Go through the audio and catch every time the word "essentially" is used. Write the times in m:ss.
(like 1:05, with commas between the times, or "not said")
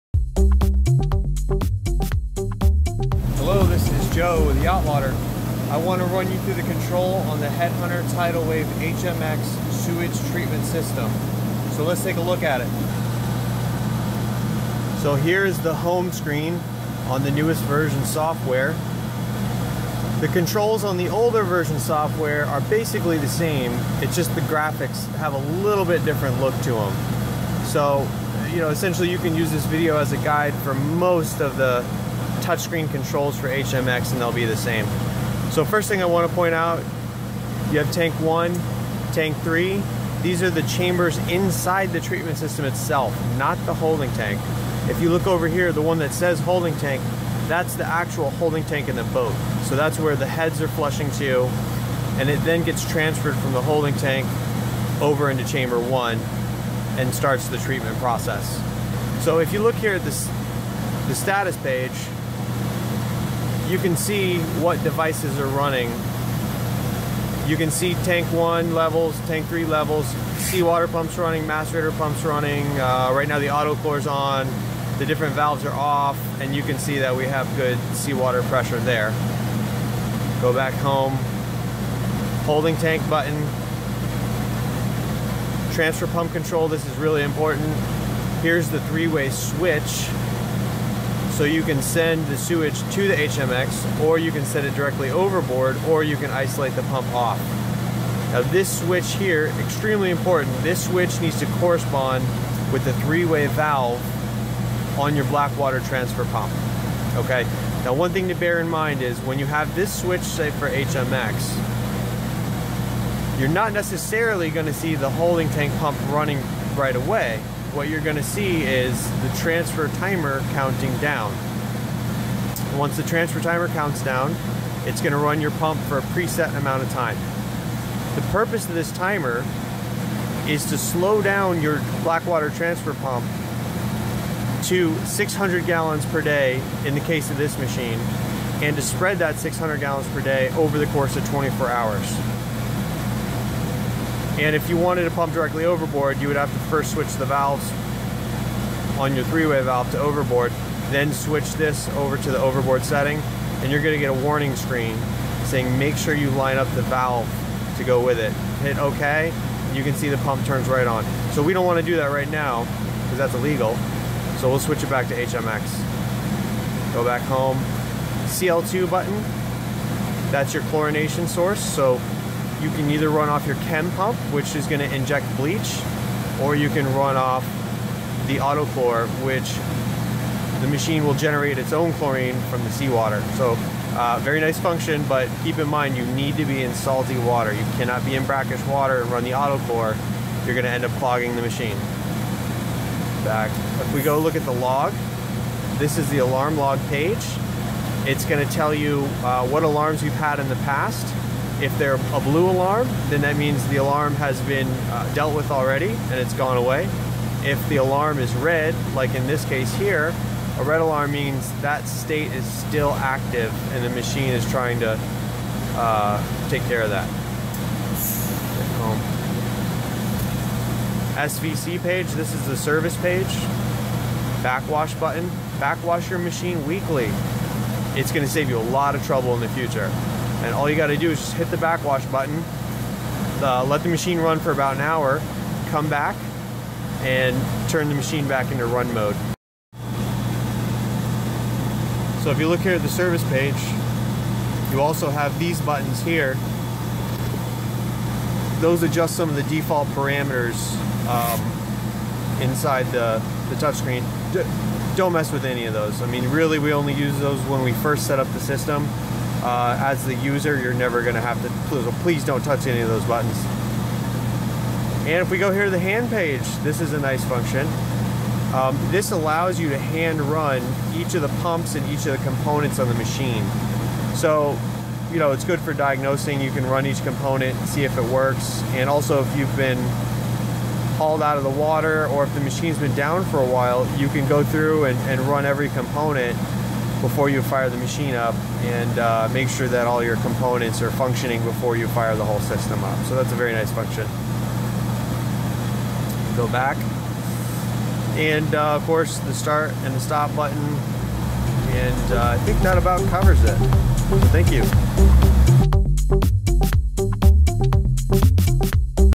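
0:28.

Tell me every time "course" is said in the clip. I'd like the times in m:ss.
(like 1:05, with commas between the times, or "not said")
2:20, 4:58.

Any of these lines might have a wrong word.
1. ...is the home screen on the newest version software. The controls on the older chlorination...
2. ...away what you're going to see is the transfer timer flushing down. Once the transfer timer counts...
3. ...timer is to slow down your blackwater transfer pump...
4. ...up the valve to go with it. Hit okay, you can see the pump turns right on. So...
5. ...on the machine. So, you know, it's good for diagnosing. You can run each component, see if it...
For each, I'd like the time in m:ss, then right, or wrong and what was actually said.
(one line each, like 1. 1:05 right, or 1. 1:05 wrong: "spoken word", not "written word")
1. 0:15 wrong: "version", not "chlorination"
2. 1:56 wrong: "counting", not "flushing"
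3. 2:08 right
4. 2:36 right
5. 4:32 right.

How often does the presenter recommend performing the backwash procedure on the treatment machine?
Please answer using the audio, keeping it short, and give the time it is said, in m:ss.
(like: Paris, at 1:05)
weekly, at 3:46.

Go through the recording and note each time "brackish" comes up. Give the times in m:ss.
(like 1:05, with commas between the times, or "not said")
3:08.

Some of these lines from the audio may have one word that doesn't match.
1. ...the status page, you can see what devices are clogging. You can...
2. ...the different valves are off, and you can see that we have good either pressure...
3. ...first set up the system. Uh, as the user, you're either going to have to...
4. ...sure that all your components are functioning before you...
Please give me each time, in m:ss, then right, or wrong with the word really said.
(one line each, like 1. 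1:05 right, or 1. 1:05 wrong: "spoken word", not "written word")
1. 1:01 wrong: "running", not "clogging"
2. 1:14 wrong: "seawater", not "either"
3. 4:17 wrong: "never", not "either"
4. 4:49 right.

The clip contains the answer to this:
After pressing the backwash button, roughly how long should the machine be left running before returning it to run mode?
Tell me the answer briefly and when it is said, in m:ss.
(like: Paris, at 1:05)
about an hour, at 3:54.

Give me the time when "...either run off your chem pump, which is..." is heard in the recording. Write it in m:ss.
2:52.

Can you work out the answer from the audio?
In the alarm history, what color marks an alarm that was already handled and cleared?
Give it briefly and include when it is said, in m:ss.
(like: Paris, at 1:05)
blue, at 3:22.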